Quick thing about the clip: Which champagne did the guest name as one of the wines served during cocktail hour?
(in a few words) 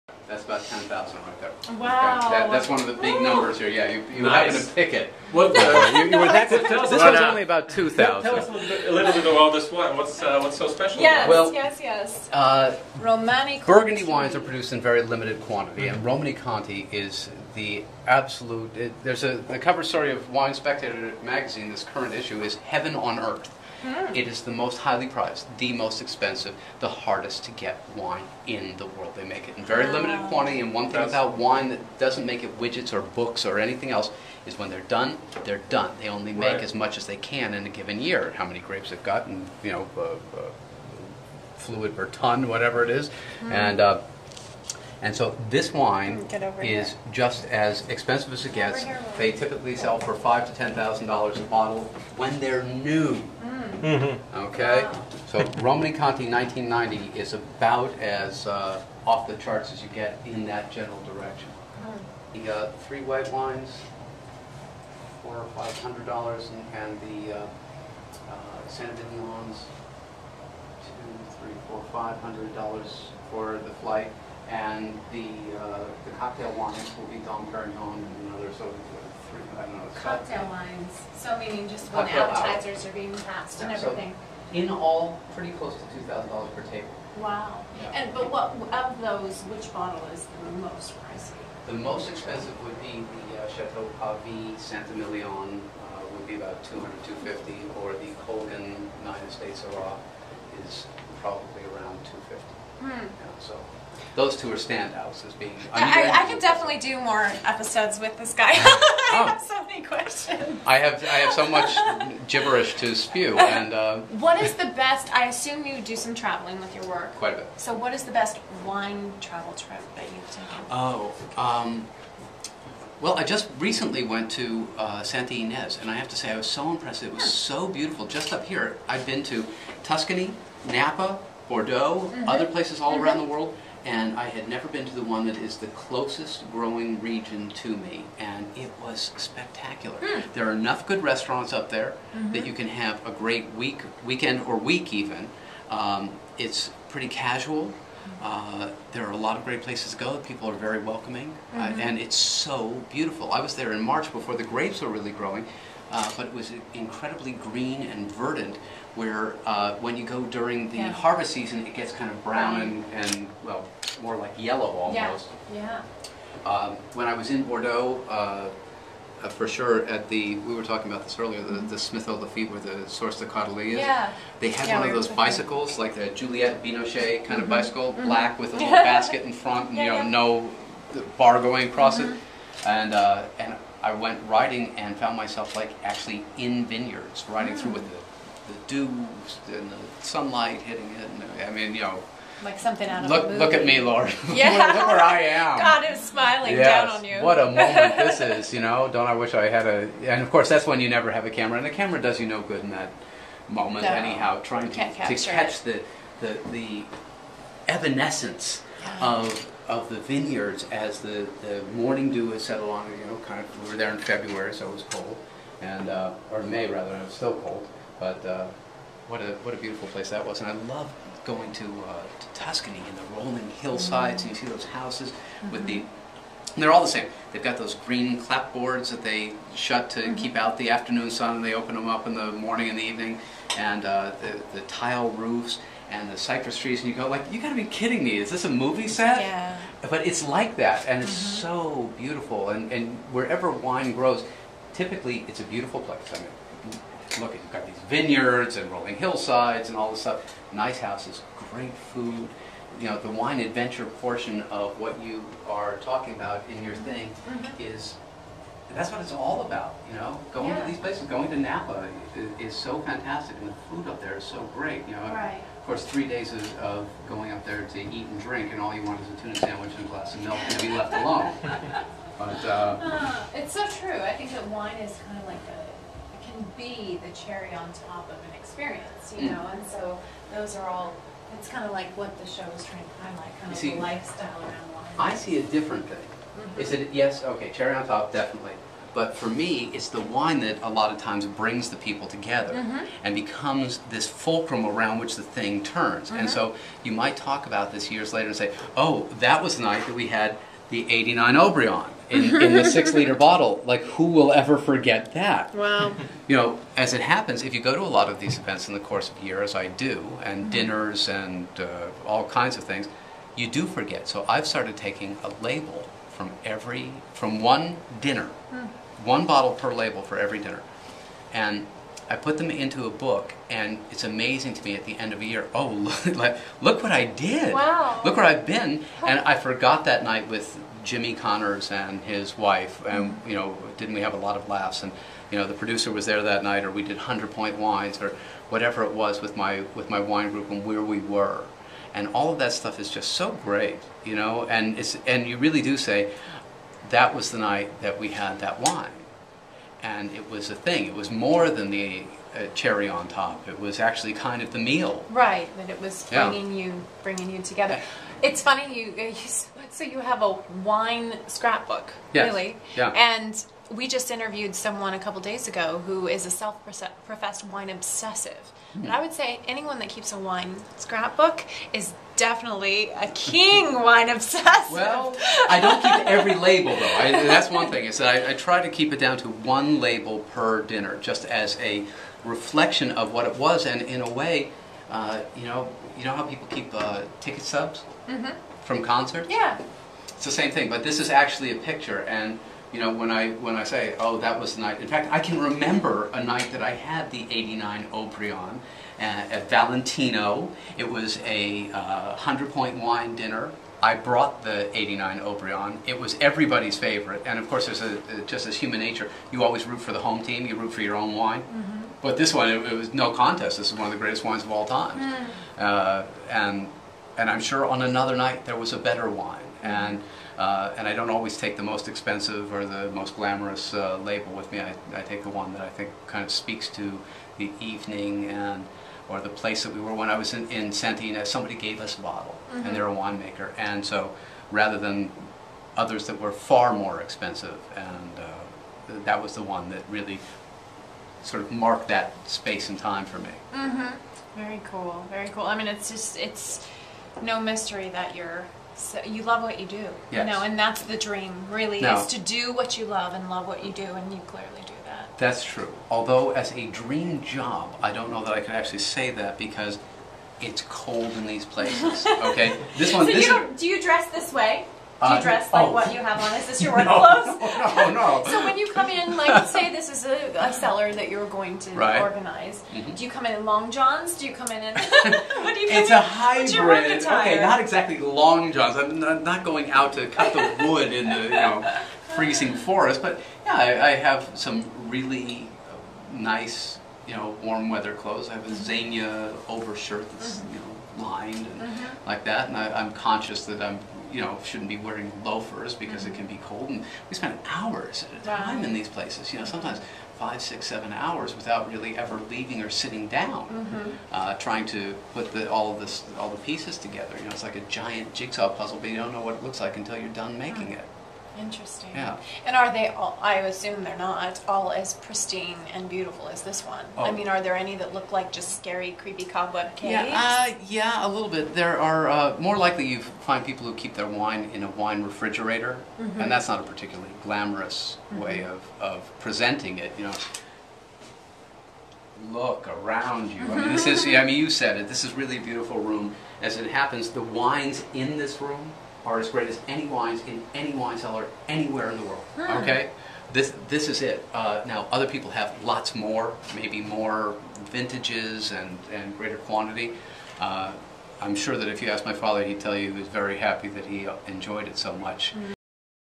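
Dom Perignon.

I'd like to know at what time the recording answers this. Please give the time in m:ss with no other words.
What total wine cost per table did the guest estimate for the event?
1:25.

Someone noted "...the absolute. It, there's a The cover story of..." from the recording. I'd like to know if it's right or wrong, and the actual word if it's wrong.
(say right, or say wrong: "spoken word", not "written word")
right.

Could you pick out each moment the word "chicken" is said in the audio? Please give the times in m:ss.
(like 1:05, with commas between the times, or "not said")
not said.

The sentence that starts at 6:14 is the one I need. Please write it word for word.
Well, I don't keep every label though.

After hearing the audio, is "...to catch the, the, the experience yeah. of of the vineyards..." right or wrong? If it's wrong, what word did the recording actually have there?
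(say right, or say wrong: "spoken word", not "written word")
wrong: "evanescence", not "experience".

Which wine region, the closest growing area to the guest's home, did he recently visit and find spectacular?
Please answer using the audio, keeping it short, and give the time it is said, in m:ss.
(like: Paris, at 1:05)
Santa Ynez, at 2:05.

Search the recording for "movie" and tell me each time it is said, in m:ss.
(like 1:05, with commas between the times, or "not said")
3:13, 3:58.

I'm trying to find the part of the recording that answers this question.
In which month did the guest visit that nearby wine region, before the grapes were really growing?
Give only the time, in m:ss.
2:33.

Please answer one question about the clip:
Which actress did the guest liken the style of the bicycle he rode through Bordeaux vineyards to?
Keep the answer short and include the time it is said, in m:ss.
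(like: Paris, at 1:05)
Juliette Binoche, at 2:56.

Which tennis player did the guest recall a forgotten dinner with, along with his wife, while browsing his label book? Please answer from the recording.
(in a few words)
Jimmy Connors.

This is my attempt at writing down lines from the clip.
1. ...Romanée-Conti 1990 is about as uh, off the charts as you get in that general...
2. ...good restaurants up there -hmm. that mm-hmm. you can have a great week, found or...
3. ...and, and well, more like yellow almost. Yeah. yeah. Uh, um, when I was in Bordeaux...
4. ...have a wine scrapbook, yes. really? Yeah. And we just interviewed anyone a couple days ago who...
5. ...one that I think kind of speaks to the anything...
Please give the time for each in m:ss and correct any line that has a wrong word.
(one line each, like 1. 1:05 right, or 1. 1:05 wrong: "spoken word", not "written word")
1. 0:55 right
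2. 2:20 wrong: "weekend", not "found"
3. 2:42 right
4. 5:59 wrong: "someone", not "anyone"
5. 7:05 wrong: "evening", not "anything".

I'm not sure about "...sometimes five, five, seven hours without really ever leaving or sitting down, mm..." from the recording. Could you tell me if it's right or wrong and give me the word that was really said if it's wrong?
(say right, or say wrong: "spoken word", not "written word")
wrong: "six", not "five".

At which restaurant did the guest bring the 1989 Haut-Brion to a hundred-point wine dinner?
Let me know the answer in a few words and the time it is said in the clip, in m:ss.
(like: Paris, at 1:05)
Valentino, at 6:39.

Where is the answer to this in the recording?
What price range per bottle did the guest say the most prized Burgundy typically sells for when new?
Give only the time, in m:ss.
0:50.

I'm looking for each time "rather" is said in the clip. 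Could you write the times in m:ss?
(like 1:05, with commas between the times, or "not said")
3:36, 7:14.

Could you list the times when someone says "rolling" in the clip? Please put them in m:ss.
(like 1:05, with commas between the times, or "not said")
3:43, 4:08.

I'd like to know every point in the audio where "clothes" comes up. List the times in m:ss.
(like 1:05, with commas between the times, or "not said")
7:46, 8:08.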